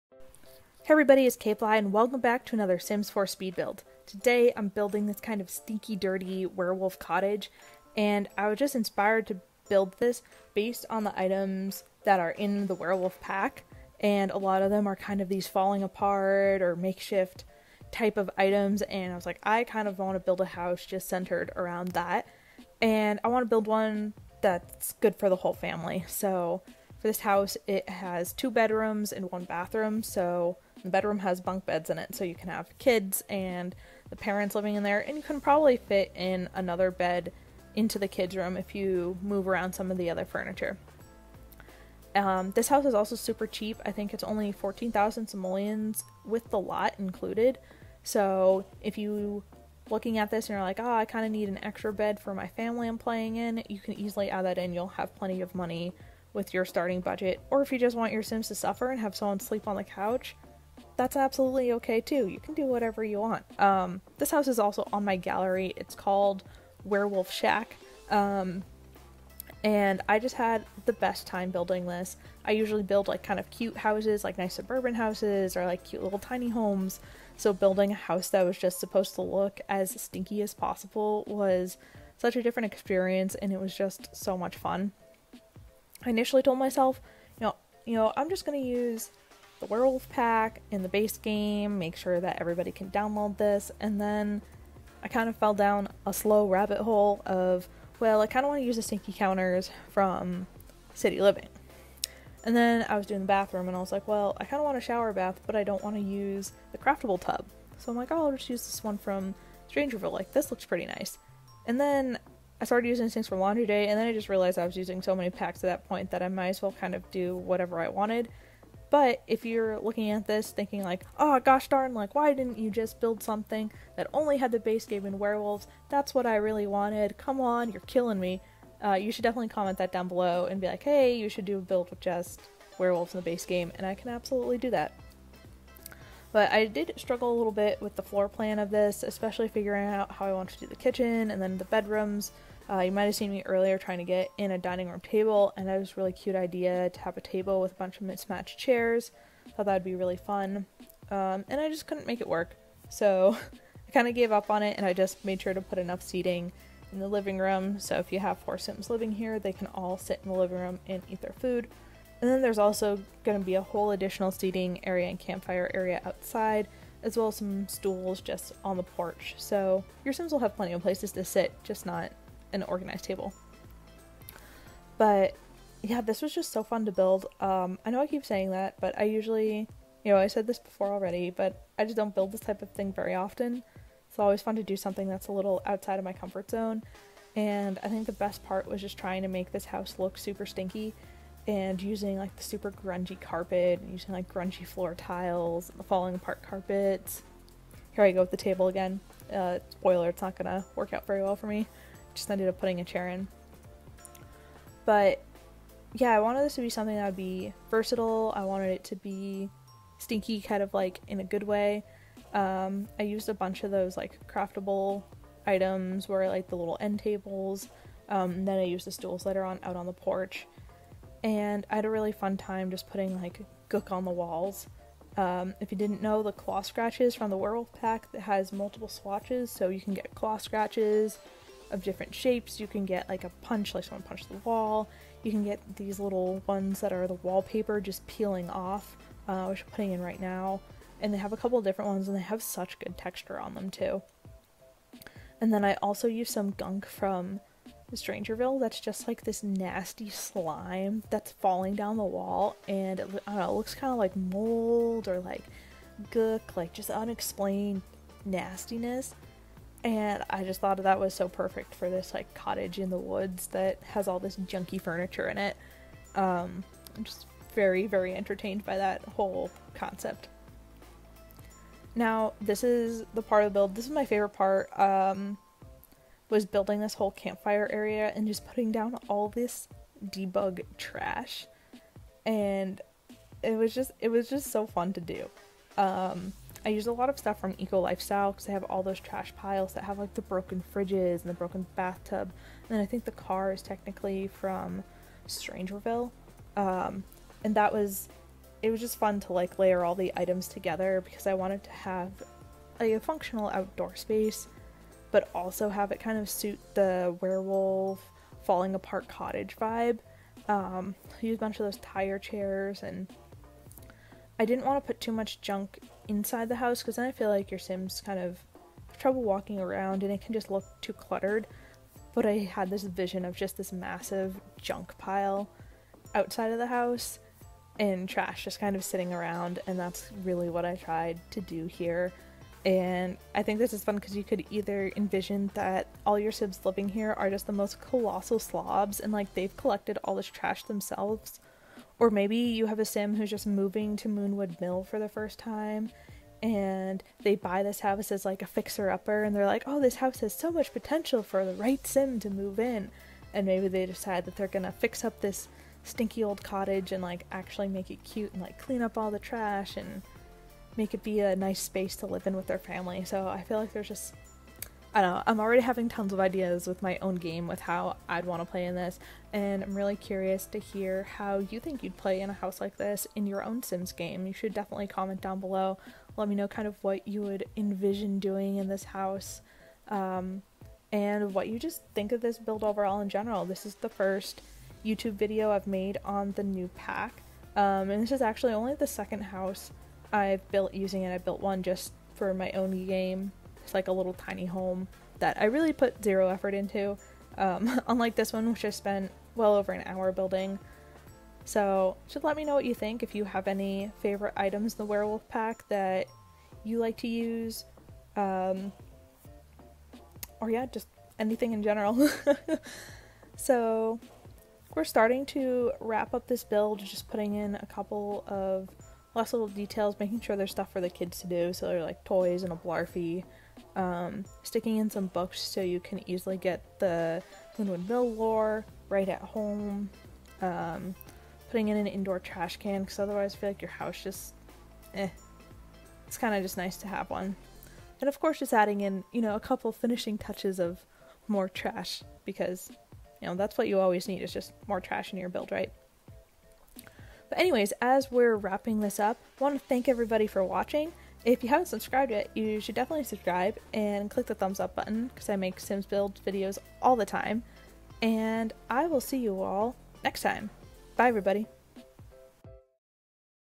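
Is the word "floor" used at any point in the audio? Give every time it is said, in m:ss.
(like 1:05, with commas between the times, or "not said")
2:18, 3:14.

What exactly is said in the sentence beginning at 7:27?
But anyways, as we're wrapping this up, I want to thank everybody for watching.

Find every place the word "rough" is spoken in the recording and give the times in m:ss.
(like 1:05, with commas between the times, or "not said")
not said.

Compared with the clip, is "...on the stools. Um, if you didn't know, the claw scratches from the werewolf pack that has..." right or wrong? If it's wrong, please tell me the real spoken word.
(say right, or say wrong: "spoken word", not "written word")
wrong: "walls", not "stools".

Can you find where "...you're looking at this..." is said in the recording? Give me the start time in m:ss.
1:59.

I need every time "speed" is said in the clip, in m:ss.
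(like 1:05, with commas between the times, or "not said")
0:03.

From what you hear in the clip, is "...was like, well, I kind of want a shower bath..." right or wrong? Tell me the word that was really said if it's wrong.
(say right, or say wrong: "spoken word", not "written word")
right.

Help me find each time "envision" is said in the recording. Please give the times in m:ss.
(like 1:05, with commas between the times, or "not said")
5:34, 6:17.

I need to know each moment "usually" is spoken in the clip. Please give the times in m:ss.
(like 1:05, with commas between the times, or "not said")
1:12, 2:59.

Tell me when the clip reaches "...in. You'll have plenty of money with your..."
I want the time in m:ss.
0:54.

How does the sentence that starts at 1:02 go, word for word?
You can do whatever you want.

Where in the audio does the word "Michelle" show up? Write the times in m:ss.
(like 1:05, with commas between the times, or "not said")
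not said.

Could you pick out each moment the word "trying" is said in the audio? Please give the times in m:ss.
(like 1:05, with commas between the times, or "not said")
2:23, 3:08.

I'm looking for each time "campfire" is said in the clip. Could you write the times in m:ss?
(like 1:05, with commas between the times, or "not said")
2:45, 4:37.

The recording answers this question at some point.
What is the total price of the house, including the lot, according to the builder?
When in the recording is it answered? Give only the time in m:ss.
0:44.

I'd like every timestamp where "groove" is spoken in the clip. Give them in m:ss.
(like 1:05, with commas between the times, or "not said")
not said.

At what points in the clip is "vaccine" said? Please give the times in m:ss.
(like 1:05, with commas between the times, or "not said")
not said.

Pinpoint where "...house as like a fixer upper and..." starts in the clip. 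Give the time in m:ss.
5:47.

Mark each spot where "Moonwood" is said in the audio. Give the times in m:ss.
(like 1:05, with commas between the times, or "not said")
5:44, 7:07.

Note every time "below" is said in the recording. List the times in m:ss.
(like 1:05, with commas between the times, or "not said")
2:10, 6:15.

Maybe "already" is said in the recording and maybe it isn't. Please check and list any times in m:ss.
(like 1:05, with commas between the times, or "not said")
3:00, 6:05.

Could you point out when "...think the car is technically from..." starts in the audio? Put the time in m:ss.
4:52.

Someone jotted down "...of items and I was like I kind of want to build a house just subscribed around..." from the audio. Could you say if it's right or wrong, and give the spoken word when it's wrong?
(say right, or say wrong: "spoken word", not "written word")
wrong: "centered", not "subscribed".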